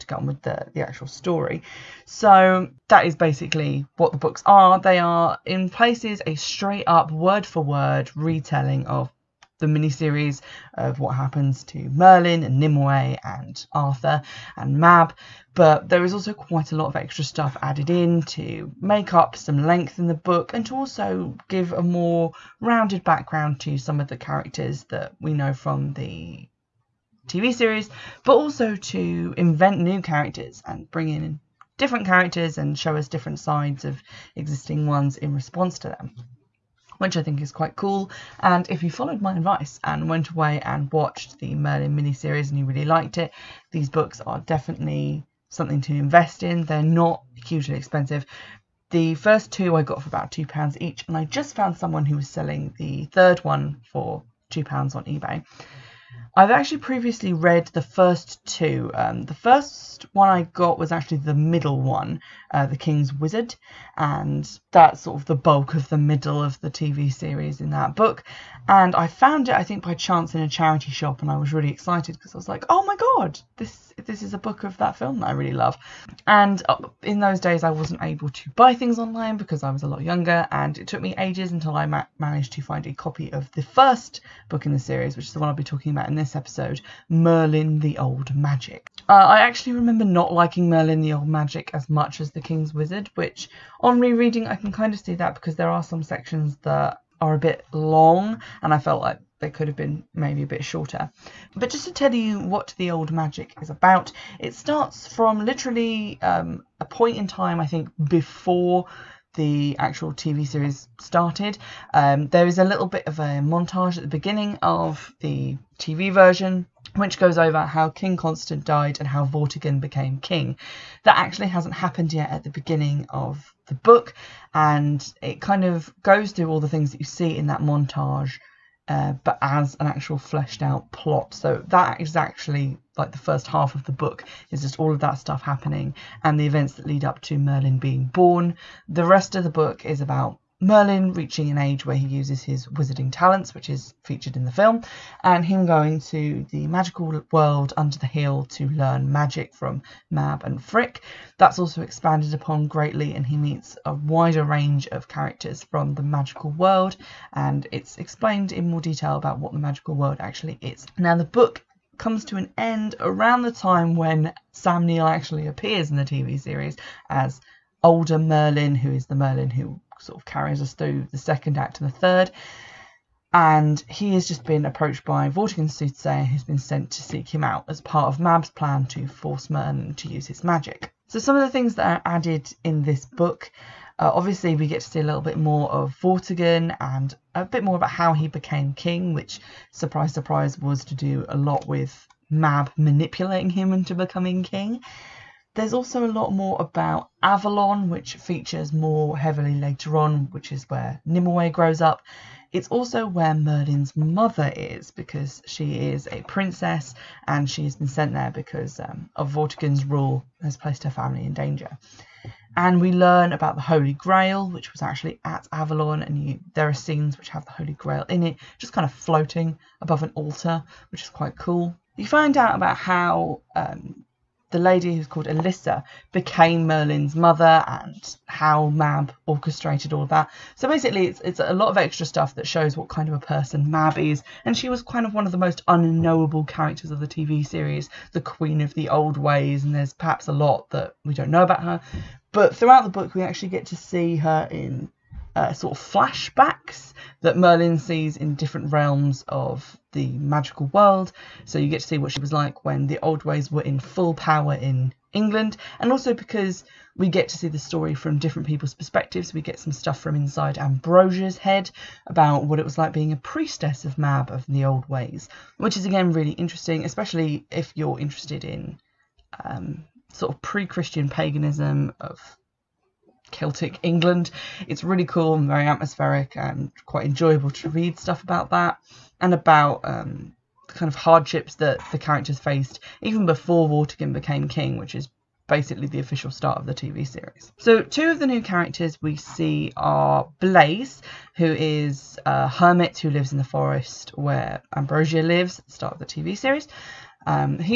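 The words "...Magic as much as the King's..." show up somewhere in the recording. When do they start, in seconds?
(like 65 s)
91 s.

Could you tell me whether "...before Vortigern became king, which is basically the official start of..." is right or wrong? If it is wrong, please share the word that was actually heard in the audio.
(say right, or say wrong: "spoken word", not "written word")
right.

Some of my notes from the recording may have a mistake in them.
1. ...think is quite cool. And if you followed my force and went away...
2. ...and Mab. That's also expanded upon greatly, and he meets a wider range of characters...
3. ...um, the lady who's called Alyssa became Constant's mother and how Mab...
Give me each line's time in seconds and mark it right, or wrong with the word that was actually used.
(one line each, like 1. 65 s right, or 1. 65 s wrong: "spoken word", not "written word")
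1. 37 s wrong: "advice", not "force"
2. 150 s wrong: "Frik", not "Mab"
3. 223 s wrong: "Merlin", not "Constant".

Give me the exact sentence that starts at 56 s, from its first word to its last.
I've actually previously read the first two.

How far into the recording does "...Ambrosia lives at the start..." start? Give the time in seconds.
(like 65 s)
294 s.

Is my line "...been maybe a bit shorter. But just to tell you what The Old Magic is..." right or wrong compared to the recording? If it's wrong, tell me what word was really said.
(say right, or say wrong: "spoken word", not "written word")
right.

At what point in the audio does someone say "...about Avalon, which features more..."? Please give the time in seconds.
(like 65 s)
196 s.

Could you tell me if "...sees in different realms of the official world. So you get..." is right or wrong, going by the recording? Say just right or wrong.
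wrong.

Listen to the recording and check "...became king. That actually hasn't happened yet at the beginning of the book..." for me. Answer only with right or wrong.
right.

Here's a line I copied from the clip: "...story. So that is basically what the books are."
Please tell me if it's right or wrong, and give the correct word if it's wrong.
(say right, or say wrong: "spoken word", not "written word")
right.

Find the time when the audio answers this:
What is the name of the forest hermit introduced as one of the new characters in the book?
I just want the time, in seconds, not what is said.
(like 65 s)
290 s.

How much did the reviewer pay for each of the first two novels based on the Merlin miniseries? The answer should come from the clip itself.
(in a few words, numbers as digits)
£2.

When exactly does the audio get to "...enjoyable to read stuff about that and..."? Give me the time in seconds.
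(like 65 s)
277 s.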